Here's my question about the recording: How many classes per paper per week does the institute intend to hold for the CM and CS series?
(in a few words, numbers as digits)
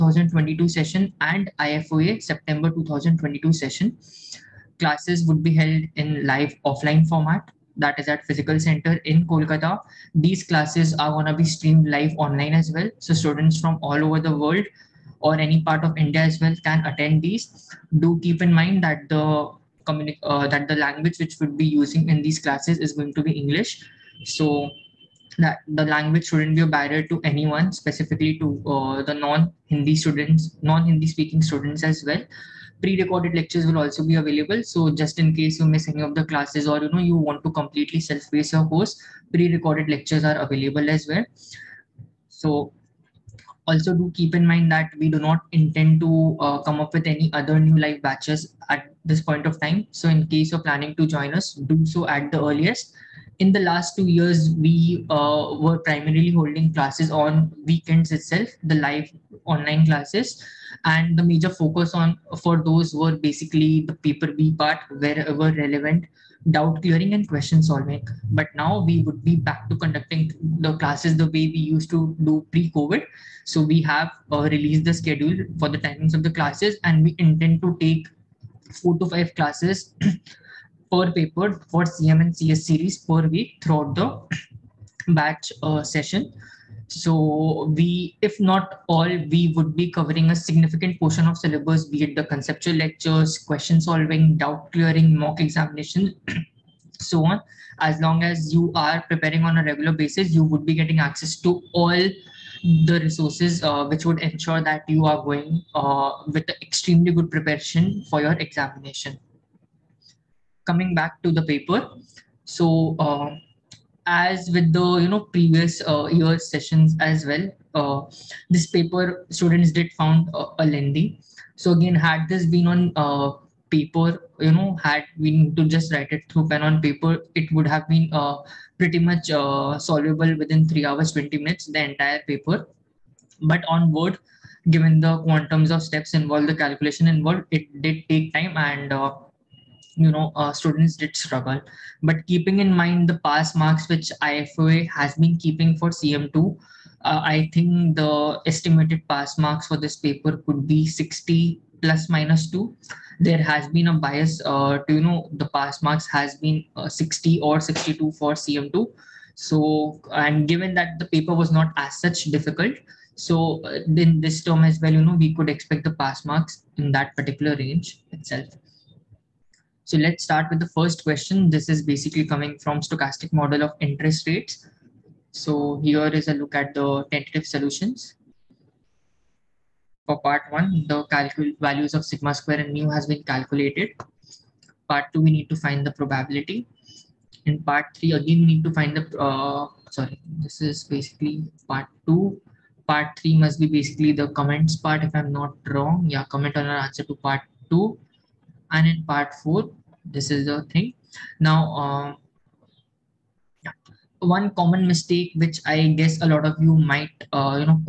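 4 to 5.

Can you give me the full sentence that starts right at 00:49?
So in case you're planning to join us, do so at the earliest.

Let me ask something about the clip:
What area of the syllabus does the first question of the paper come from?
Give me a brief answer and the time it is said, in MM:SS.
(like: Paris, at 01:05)
Stochastic model of interest rates, at 02:52.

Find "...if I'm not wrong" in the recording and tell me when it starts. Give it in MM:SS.
03:15.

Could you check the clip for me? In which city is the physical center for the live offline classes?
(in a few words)
Kolkata.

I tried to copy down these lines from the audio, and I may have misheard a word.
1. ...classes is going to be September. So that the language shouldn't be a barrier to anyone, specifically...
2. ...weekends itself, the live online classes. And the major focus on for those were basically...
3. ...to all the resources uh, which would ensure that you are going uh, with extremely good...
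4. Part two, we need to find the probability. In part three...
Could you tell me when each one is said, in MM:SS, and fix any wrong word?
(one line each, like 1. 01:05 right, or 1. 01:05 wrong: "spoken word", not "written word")
1. 00:22 wrong: "English", not "September"
2. 00:57 right
3. 01:41 right
4. 03:04 right.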